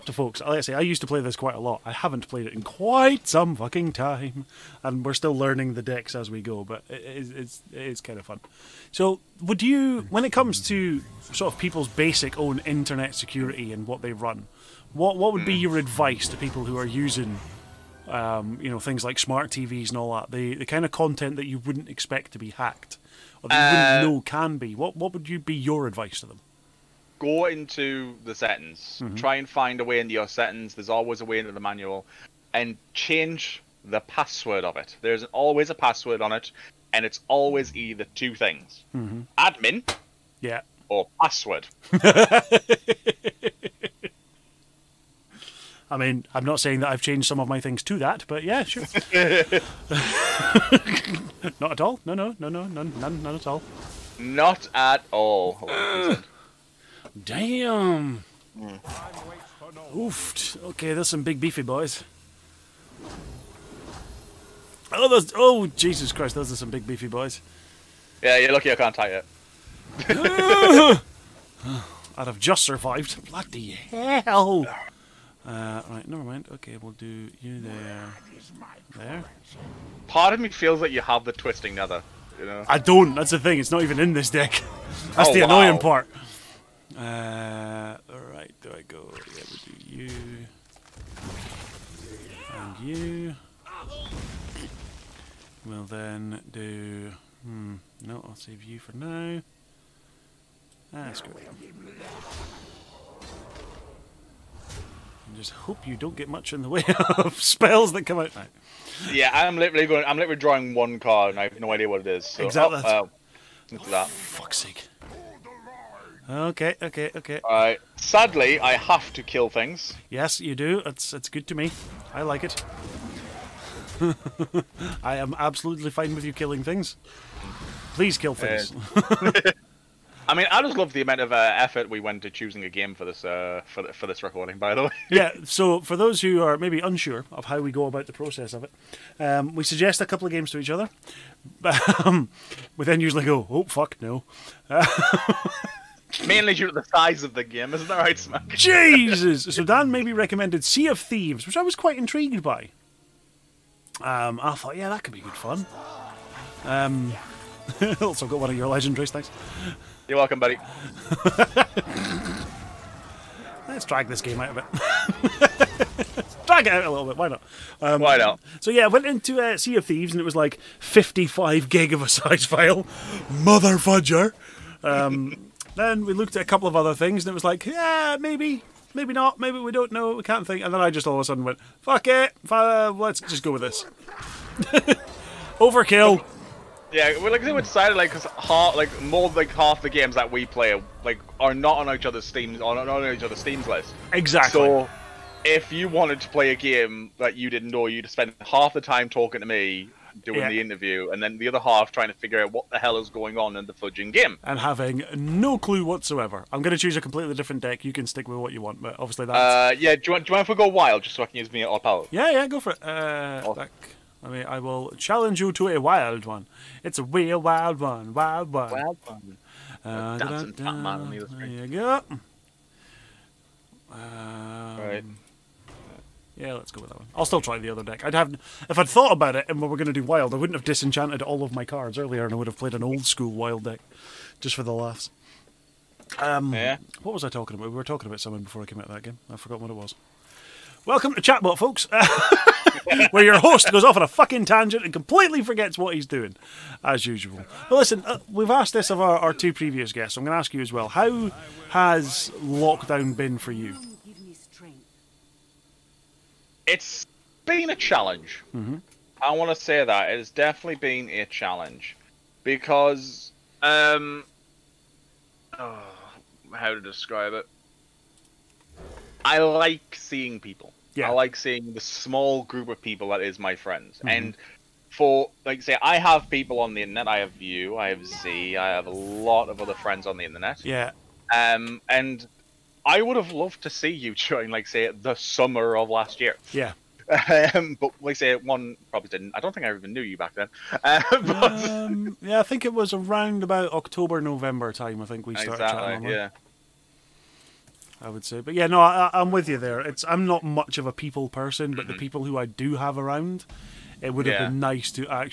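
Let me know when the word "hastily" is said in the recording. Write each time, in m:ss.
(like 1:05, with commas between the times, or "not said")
not said.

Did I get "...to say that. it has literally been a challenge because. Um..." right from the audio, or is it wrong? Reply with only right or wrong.
wrong.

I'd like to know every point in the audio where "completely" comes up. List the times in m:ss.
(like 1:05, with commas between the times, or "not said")
3:26, 4:04.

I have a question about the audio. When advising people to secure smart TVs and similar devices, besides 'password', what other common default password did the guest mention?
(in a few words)
admin.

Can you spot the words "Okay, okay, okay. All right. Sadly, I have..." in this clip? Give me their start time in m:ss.
1:56.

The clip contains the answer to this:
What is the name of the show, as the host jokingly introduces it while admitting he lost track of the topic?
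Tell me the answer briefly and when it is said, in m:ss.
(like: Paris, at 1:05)
Chatbot, at 4:01.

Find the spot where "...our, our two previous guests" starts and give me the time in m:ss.
4:08.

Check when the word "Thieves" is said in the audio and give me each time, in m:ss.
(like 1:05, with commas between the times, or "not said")
2:30, 2:49.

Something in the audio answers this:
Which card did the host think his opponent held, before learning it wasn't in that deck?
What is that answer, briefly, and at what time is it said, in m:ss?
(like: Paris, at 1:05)
Twisting Nether, at 1:21.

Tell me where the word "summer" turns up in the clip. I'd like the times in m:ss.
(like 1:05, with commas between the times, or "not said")
4:45.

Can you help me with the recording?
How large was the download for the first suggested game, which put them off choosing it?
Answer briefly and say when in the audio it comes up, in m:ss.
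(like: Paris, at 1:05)
55 GB, at 2:50.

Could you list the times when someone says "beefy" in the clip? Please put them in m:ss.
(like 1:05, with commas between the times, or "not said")
1:01, 1:06.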